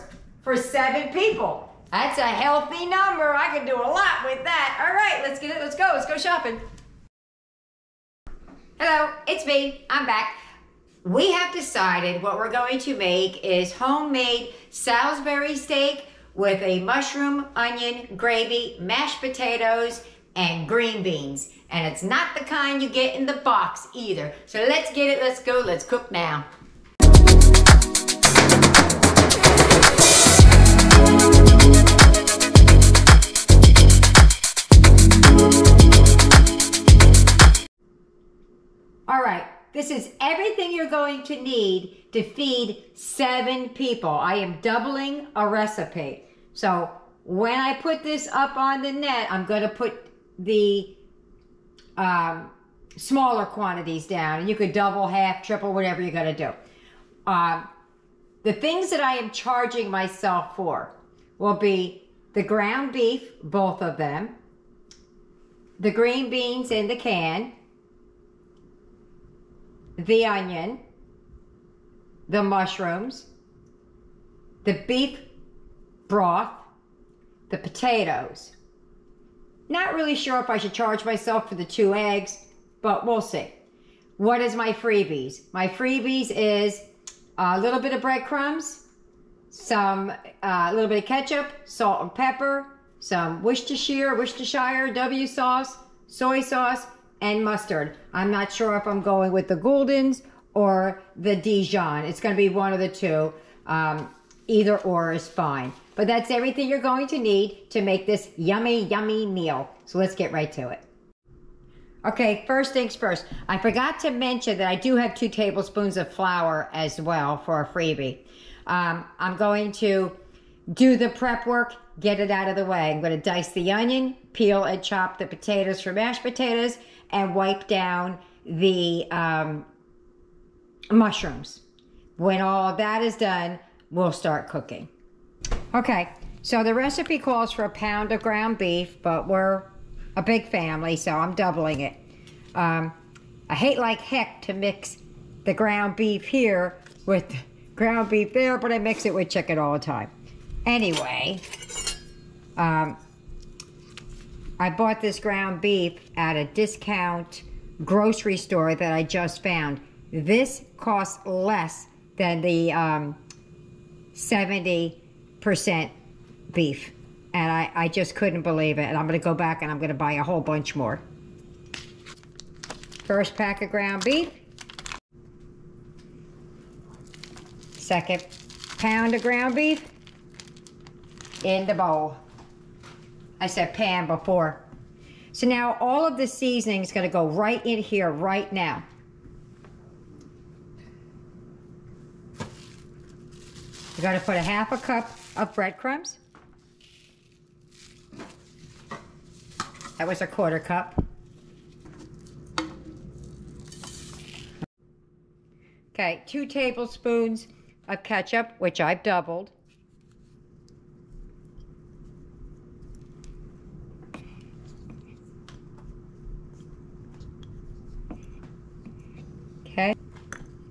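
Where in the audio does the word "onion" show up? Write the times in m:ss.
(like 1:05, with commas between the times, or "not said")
0:17, 1:10, 2:03.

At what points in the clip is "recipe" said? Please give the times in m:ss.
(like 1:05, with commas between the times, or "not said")
0:45, 2:16.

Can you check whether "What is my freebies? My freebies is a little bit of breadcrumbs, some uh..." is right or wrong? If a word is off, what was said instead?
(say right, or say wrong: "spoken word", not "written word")
right.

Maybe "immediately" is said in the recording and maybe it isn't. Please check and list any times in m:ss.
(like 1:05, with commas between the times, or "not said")
not said.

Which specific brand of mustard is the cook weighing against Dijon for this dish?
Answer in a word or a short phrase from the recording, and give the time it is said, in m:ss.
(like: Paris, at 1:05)
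Gulden's, at 1:39.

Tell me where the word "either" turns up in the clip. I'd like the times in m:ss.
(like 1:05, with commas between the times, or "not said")
0:23, 1:44.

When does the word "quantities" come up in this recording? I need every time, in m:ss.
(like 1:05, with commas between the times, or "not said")
0:53.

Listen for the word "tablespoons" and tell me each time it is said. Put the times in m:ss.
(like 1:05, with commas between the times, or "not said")
1:55, 3:26.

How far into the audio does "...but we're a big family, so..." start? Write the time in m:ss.
2:19.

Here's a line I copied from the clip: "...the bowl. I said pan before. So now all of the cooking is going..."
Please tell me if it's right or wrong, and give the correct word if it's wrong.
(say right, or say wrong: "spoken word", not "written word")
wrong: "seasoning", not "cooking".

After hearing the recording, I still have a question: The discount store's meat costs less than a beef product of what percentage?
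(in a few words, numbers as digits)
70%.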